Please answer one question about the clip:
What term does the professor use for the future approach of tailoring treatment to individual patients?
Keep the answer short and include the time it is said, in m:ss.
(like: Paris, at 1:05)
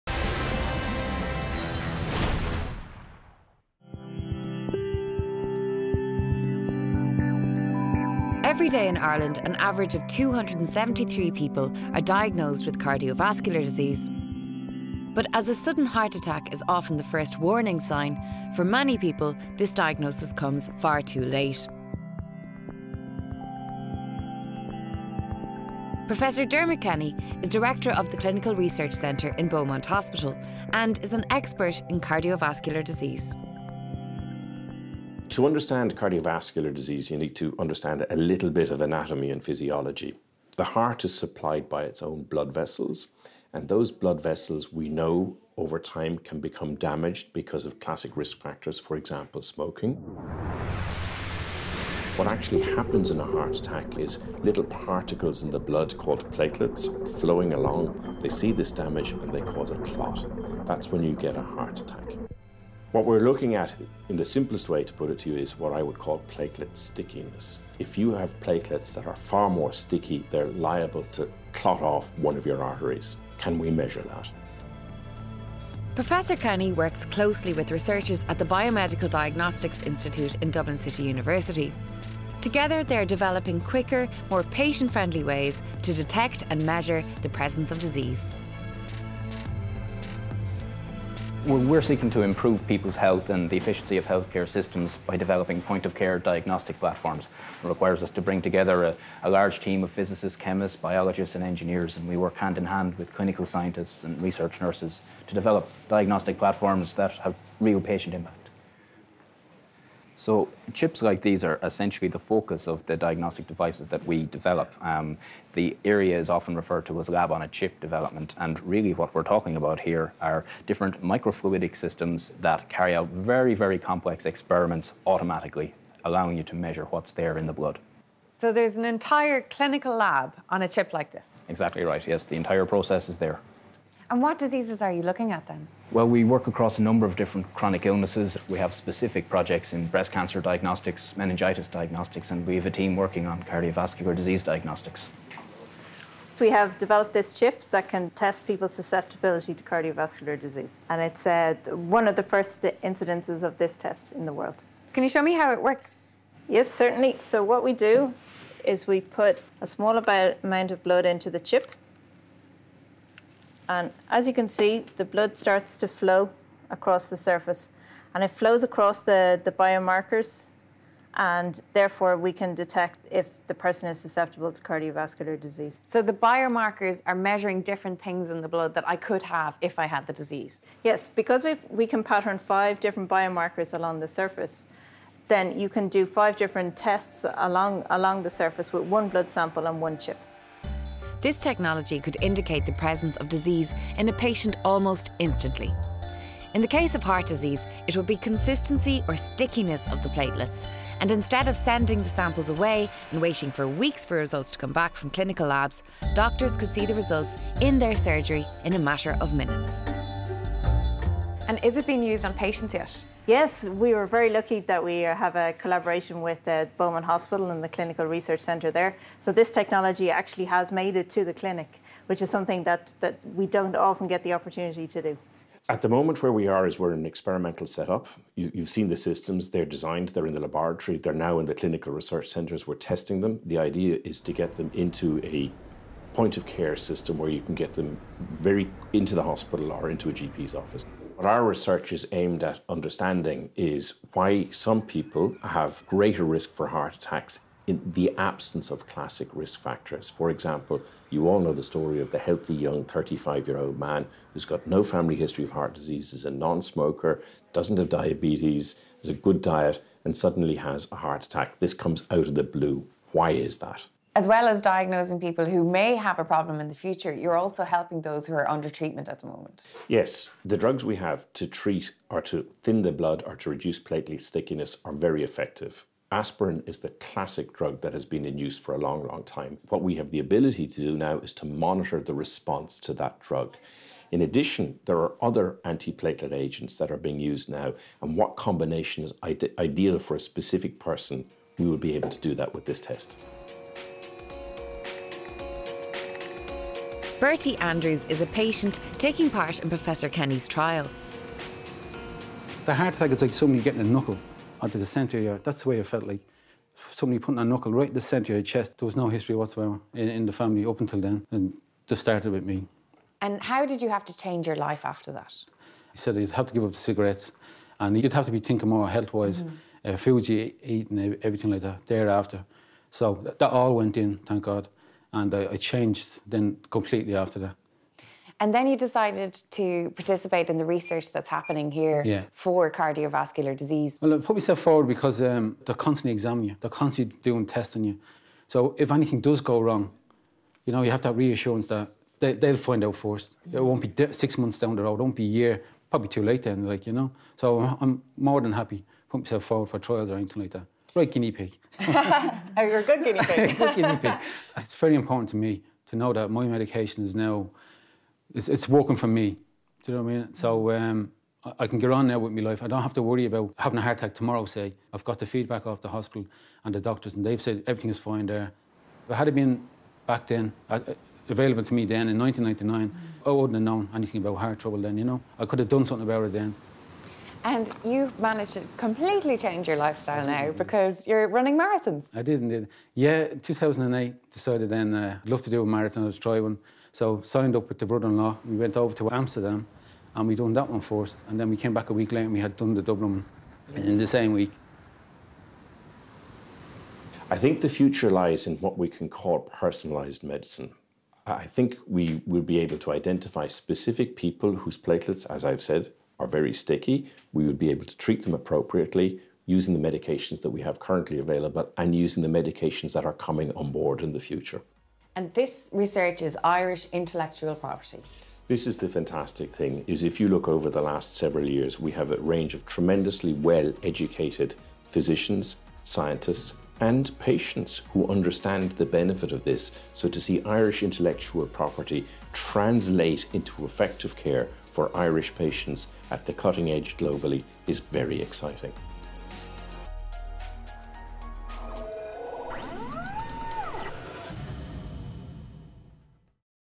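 Personalized medicine, at 6:39.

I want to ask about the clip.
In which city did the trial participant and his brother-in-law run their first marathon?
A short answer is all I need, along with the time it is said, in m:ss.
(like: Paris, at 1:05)
Amsterdam, at 6:29.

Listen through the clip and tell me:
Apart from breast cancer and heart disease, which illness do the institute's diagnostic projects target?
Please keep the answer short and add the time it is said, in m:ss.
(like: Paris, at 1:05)
Meningitis, at 2:21.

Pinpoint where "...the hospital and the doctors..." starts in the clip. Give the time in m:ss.
6:05.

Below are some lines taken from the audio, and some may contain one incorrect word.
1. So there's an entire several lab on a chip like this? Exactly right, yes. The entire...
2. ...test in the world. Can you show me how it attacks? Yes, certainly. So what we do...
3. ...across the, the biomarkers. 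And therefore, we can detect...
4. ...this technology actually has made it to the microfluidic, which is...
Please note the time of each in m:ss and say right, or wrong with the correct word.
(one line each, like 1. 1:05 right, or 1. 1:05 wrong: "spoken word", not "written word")
1. 2:08 wrong: "clinical", not "several"
2. 2:33 wrong: "works", not "attacks"
3. 2:48 right
4. 3:39 wrong: "clinic", not "microfluidic".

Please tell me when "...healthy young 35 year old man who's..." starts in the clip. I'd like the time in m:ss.
4:12.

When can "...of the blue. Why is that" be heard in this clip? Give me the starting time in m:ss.
4:22.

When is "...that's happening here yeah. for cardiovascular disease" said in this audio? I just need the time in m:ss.
5:31.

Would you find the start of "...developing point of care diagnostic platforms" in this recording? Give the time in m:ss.
1:35.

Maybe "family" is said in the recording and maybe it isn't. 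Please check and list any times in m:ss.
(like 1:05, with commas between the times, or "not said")
4:14, 5:10.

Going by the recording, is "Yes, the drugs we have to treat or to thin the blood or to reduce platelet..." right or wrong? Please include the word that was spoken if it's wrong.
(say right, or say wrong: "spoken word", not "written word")
right.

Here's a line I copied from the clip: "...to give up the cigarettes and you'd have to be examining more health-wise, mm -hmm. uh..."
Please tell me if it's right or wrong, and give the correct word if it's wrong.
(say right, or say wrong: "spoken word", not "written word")
wrong: "thinking", not "examining".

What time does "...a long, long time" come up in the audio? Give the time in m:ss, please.
4:38.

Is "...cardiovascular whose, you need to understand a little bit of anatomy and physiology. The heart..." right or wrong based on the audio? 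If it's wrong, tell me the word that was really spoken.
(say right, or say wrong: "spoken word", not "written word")
wrong: "disease", not "whose".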